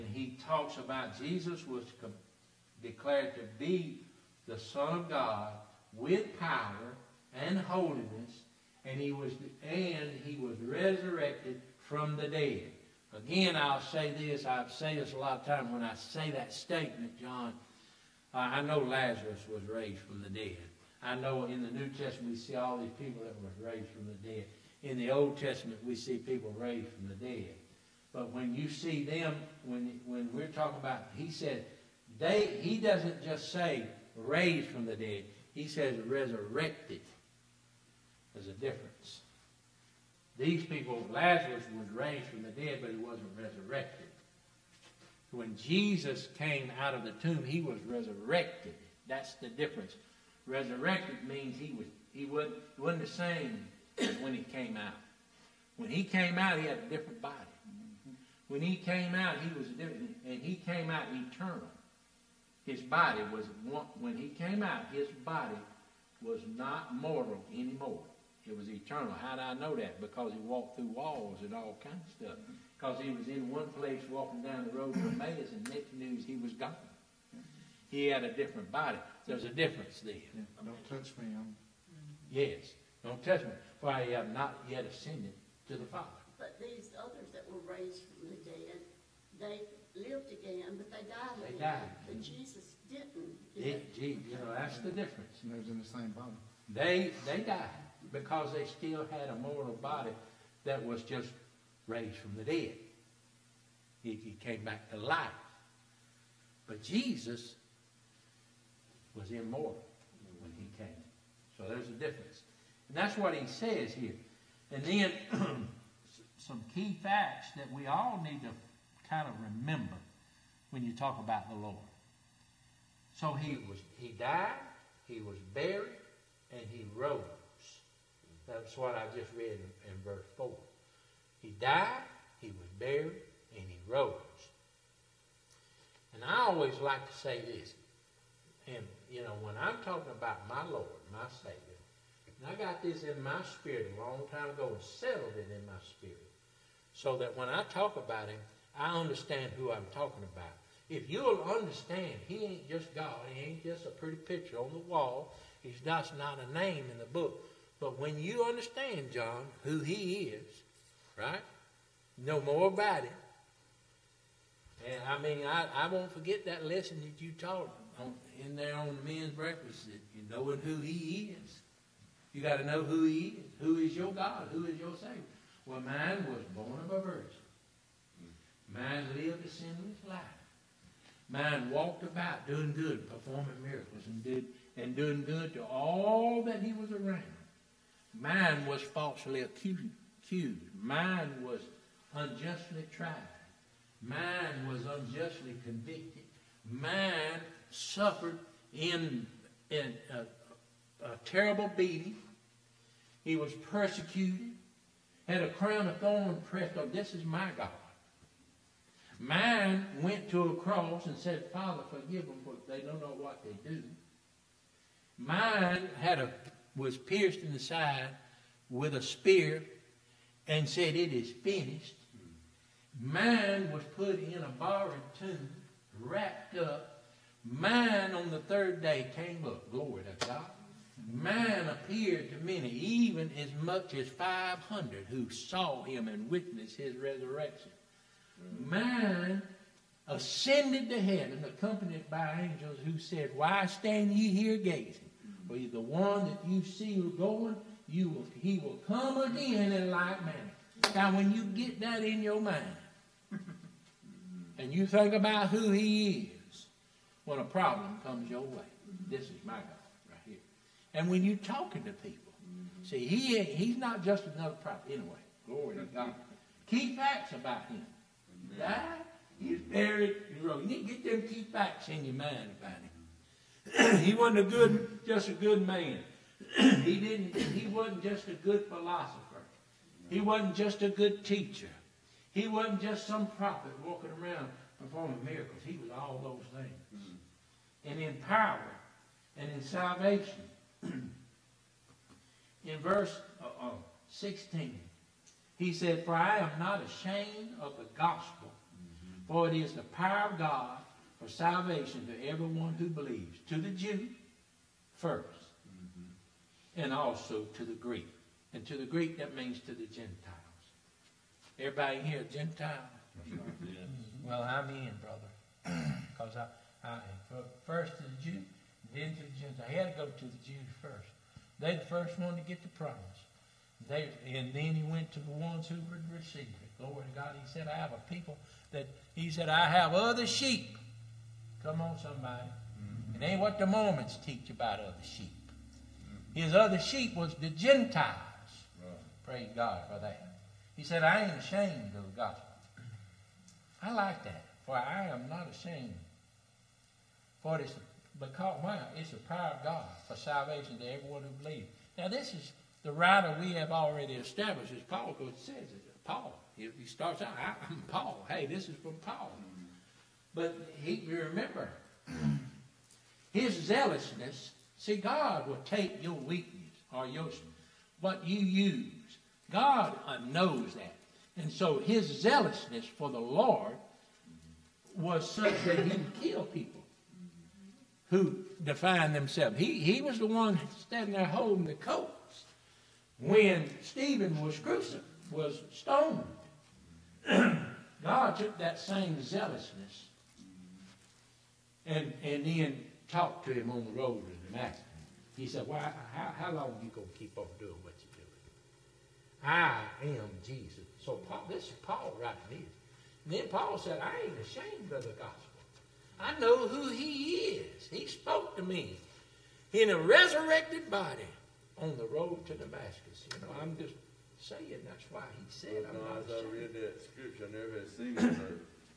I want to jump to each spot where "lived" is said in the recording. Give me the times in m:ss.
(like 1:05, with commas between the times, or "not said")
1:29, 2:59.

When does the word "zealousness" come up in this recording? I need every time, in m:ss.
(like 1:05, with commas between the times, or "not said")
6:03, 6:12, 6:29.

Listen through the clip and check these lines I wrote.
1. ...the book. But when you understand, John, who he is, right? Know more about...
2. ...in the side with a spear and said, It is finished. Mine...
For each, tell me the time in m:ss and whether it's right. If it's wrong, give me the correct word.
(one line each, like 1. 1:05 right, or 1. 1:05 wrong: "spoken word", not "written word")
1. 2:36 right
2. 3:37 right.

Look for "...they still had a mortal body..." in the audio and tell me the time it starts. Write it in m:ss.
1:38.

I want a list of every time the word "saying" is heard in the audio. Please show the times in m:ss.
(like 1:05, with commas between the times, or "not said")
6:54.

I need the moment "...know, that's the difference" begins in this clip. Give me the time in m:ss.
1:34.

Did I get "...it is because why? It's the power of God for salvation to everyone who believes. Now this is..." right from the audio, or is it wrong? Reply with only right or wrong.
right.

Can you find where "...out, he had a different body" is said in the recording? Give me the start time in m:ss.
0:56.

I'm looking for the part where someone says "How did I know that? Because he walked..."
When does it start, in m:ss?
1:09.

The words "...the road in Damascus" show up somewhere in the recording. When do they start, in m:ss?
6:33.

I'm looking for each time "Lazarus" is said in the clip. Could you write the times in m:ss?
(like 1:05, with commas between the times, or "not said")
0:18, 0:41.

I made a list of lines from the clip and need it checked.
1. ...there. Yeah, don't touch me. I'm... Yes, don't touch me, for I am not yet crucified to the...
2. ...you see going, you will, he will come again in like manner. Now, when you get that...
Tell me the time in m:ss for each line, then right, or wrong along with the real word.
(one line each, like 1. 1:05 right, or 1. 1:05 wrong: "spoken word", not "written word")
1. 1:19 wrong: "ascended", not "crucified"
2. 4:06 right.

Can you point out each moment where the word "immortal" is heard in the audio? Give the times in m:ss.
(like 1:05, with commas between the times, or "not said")
1:49.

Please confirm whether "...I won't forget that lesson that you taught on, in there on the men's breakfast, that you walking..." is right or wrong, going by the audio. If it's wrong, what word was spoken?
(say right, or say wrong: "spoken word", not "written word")
wrong: "knowing", not "walking".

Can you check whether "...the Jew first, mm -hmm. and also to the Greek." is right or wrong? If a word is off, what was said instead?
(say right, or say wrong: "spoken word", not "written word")
right.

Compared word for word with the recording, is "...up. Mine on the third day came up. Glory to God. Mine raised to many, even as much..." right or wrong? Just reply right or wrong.
wrong.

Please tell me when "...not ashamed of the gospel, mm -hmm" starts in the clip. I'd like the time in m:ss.
4:56.